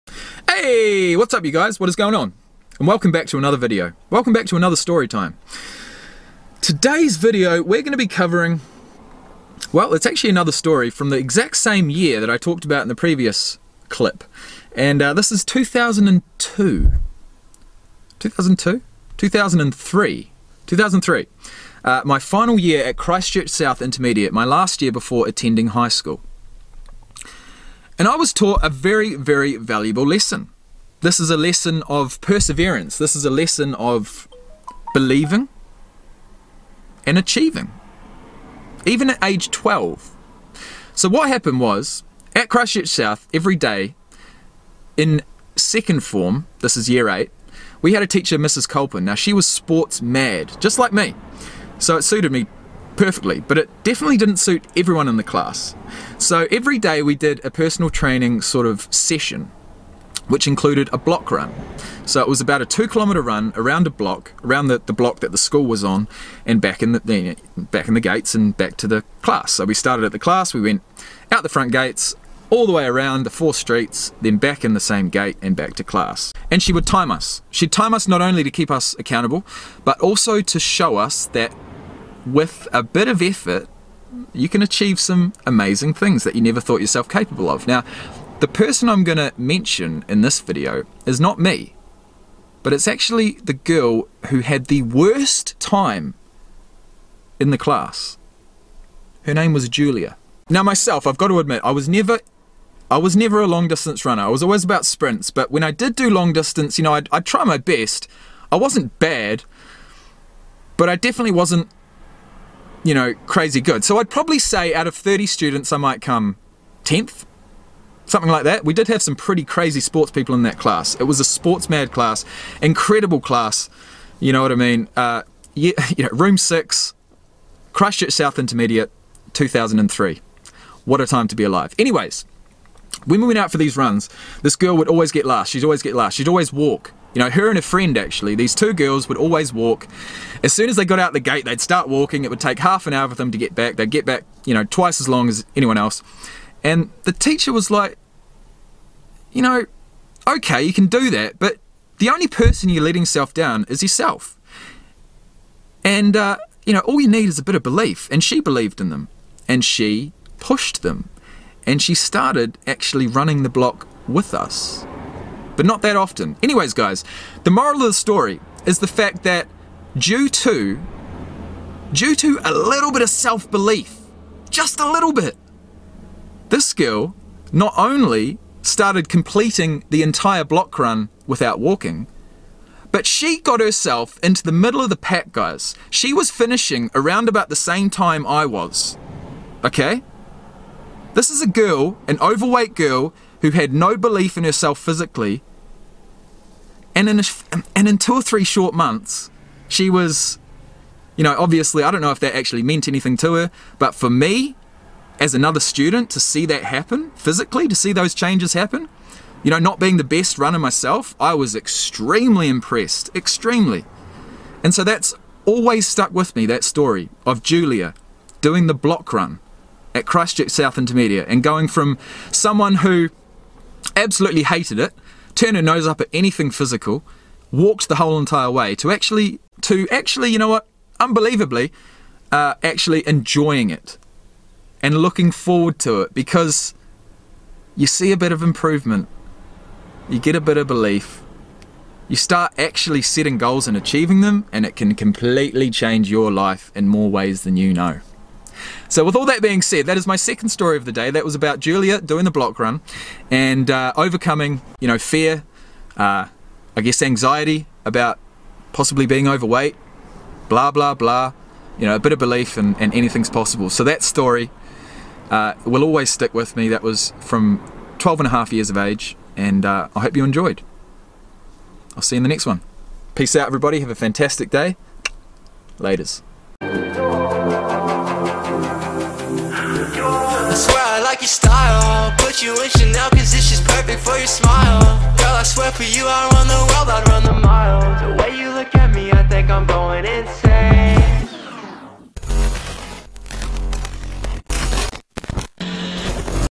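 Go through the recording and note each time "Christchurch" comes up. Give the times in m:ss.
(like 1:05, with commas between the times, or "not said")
0:22, 0:42, 3:40.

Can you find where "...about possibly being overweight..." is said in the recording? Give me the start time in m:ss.
4:17.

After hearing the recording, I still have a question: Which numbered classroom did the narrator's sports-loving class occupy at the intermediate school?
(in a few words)
Room 6.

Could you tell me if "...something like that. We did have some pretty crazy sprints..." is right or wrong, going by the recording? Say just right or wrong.
wrong.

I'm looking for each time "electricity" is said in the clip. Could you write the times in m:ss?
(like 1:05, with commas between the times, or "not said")
not said.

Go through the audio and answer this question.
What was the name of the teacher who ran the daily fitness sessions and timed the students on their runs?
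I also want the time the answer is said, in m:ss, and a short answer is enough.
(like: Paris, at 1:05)
Mrs. Colpin, at 0:48.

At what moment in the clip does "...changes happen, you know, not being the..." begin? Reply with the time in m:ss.
3:28.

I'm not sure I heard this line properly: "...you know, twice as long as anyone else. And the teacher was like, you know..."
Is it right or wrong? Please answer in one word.
right.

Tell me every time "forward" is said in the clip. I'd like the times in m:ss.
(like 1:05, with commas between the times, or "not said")
3:55.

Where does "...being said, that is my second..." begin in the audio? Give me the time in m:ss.
4:09.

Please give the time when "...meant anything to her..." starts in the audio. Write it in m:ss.
3:22.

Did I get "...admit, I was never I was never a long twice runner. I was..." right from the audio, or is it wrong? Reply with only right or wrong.
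wrong.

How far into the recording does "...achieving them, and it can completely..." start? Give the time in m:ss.
4:03.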